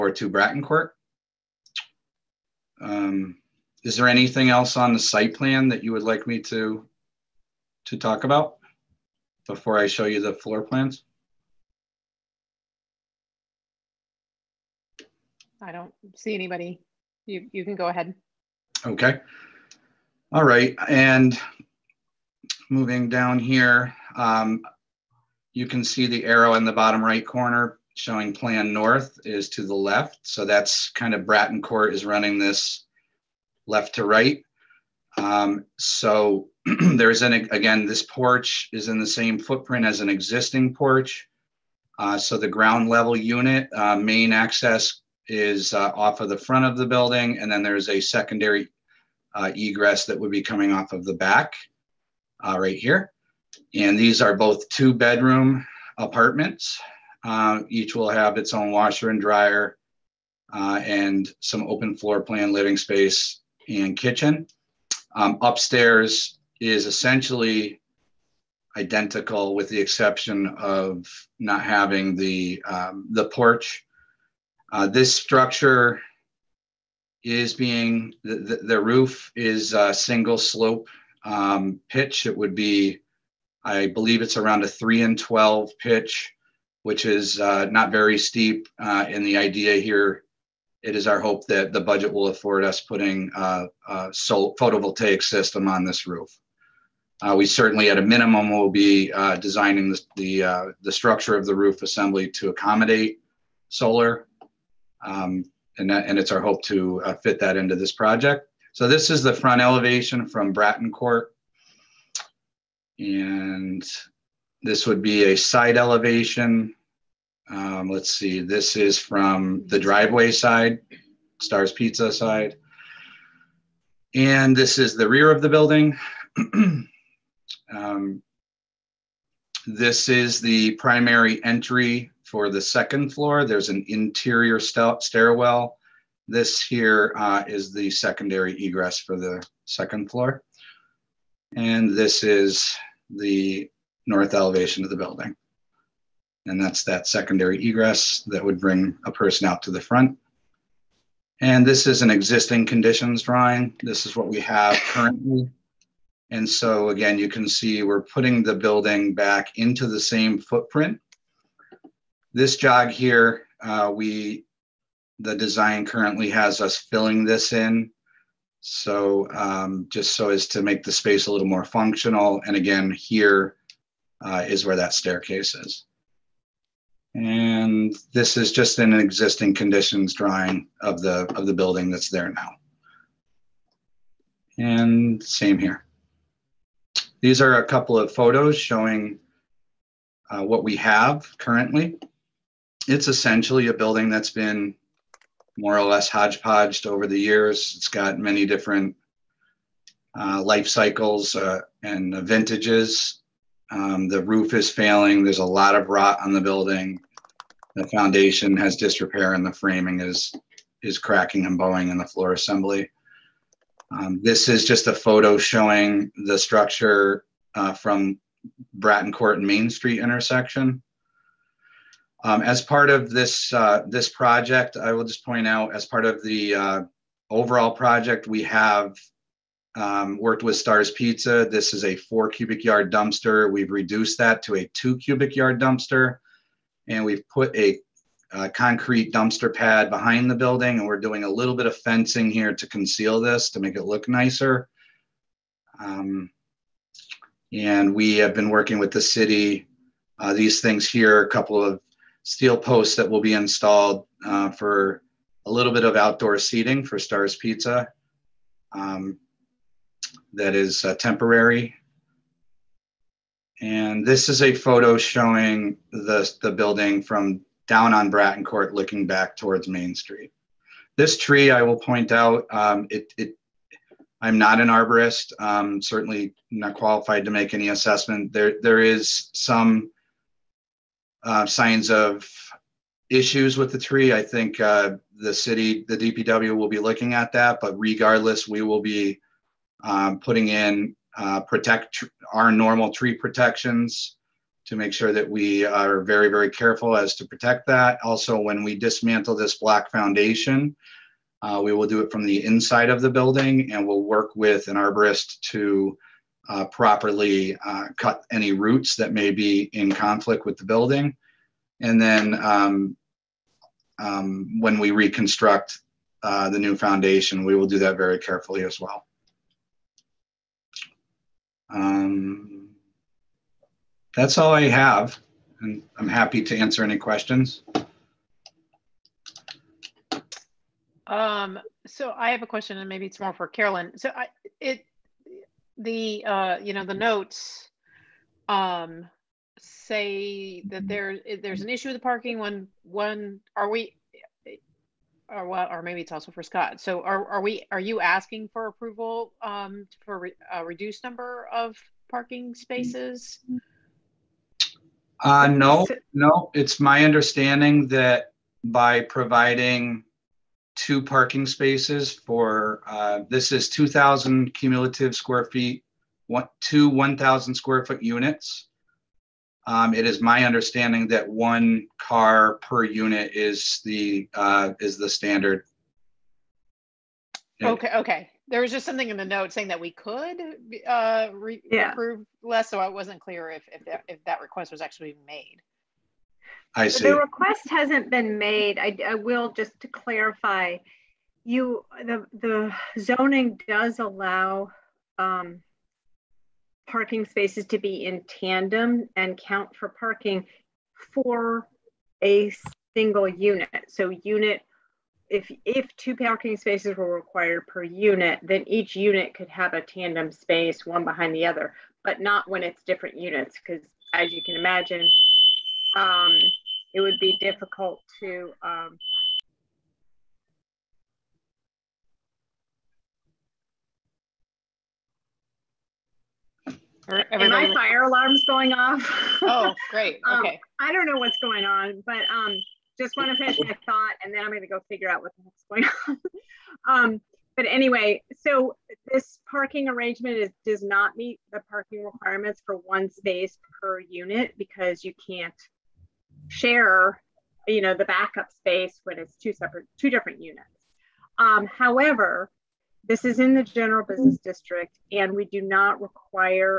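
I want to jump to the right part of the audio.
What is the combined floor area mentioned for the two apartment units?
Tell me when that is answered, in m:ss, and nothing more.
6:03.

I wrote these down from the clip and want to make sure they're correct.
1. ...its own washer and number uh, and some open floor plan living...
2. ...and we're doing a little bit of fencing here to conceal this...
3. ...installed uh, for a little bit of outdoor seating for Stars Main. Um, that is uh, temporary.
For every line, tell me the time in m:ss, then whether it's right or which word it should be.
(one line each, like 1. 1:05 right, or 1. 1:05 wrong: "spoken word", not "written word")
1. 0:58 wrong: "dryer", not "number"
2. 4:00 right
3. 4:13 wrong: "Pizza", not "Main".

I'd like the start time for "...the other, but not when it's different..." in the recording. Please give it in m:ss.
6:51.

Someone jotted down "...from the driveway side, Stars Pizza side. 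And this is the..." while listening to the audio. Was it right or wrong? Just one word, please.
right.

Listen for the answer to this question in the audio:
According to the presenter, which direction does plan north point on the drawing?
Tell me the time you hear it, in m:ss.
0:28.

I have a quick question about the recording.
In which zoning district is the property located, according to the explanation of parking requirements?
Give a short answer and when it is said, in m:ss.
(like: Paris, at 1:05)
General business district, at 7:33.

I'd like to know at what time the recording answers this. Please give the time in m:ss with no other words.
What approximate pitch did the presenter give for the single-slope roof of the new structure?
1:24.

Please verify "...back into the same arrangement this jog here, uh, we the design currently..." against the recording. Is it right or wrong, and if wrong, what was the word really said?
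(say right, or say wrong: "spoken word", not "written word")
wrong: "footprint", not "arrangement".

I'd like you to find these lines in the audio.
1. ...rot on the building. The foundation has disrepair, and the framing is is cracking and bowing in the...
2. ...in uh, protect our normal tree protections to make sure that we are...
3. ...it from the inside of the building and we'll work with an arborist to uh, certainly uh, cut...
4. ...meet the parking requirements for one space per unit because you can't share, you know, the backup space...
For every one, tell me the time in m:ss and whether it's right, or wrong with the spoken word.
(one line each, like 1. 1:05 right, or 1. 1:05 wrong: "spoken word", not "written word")
1. 3:25 right
2. 4:50 right
3. 5:02 wrong: "properly", not "certainly"
4. 7:21 right.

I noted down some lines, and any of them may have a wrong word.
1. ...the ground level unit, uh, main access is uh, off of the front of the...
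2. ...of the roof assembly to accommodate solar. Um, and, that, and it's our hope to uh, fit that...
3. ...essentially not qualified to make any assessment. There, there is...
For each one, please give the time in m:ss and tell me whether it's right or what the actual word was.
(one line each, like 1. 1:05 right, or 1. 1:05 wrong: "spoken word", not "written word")
1. 0:42 right
2. 1:41 right
3. 4:35 wrong: "certainly", not "essentially".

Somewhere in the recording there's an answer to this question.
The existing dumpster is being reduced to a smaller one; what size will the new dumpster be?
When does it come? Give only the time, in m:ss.
3:54.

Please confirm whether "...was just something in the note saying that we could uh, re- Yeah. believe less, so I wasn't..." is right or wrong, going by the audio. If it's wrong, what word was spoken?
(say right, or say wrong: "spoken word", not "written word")
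wrong: "approve", not "believe".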